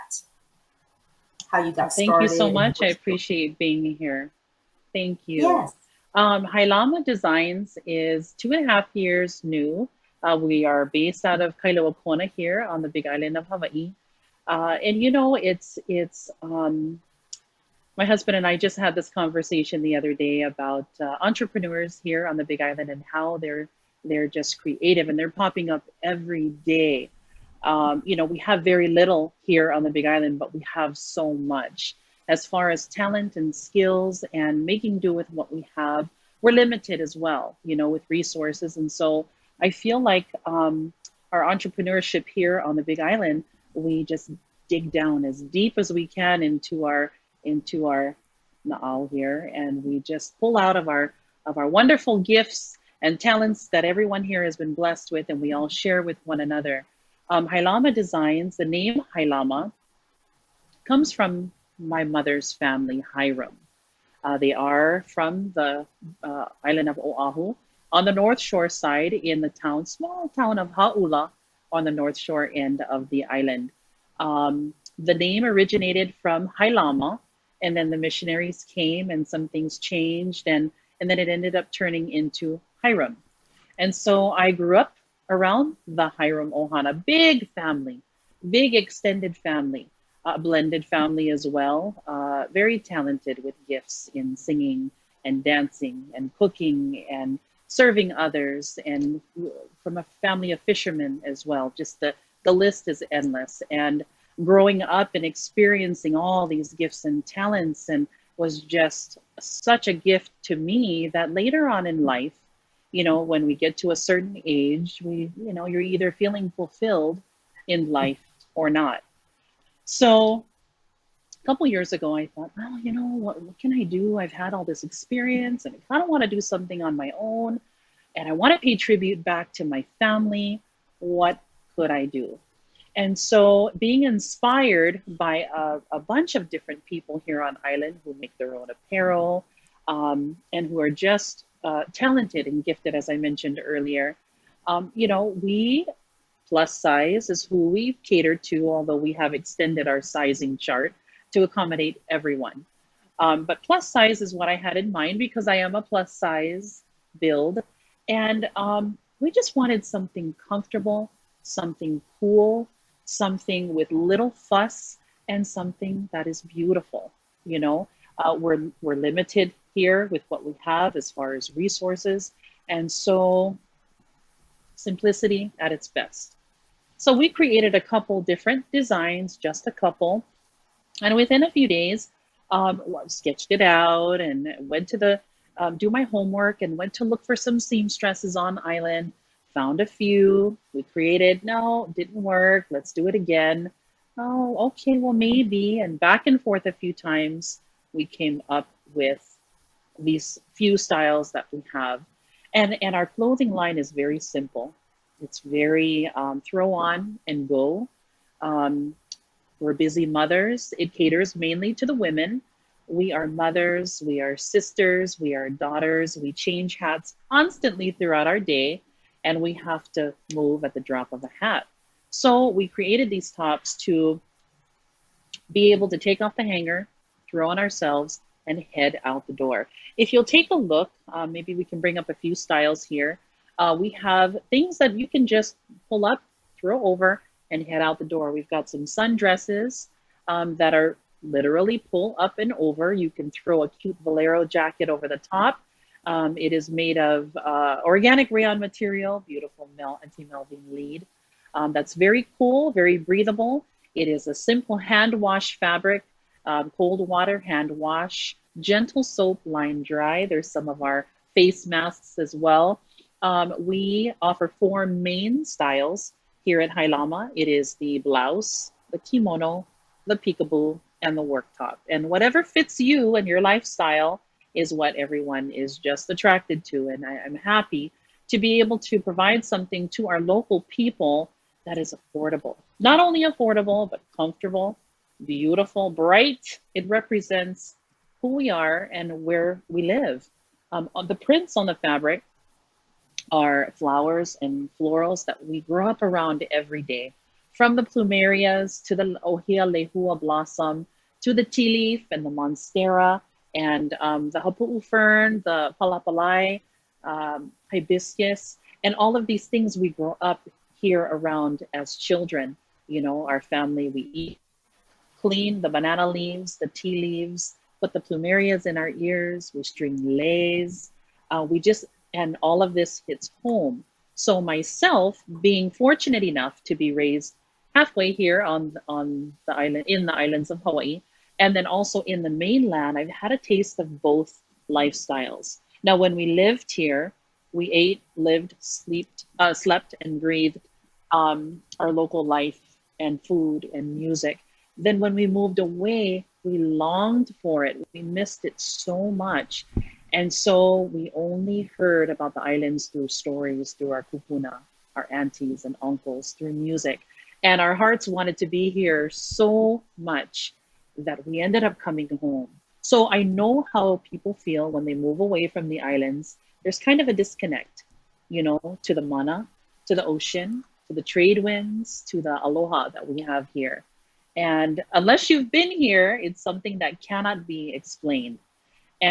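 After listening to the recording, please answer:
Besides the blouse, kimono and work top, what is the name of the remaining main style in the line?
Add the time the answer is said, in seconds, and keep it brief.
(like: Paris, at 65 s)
peekaboo, at 270 s.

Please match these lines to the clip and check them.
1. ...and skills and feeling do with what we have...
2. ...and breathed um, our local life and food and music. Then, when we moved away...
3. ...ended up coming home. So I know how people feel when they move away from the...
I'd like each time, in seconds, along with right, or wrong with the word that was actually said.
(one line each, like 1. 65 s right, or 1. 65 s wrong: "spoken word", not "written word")
1. 33 s wrong: "making", not "feeling"
2. 340 s right
3. 361 s right.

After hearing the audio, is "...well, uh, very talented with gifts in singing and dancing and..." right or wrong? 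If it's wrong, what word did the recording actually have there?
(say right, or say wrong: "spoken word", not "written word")
right.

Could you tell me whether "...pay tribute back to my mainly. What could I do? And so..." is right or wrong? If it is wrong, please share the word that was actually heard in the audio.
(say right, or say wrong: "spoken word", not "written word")
wrong: "family", not "mainly".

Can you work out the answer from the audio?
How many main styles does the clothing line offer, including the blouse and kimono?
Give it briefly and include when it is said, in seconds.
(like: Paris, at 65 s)
4, at 264 s.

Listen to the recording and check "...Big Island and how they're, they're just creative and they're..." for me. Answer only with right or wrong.
right.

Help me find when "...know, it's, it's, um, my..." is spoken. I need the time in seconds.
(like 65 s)
15 s.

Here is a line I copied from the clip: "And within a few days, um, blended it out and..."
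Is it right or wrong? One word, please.
wrong.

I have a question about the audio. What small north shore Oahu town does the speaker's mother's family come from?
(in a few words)
Hauula.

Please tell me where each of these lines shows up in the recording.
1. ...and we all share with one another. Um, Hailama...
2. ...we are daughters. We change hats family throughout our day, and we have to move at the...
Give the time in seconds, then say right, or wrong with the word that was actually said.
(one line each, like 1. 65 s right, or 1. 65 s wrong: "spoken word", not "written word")
1. 55 s right
2. 215 s wrong: "constantly", not "family".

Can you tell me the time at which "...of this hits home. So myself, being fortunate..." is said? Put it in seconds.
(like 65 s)
322 s.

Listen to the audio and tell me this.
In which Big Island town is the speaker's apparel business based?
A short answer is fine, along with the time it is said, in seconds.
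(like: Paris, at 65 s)
Kailua Kona, at 11 s.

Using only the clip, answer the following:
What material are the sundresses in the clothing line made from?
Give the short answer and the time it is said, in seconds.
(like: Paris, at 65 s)
organic rayon, at 247 s.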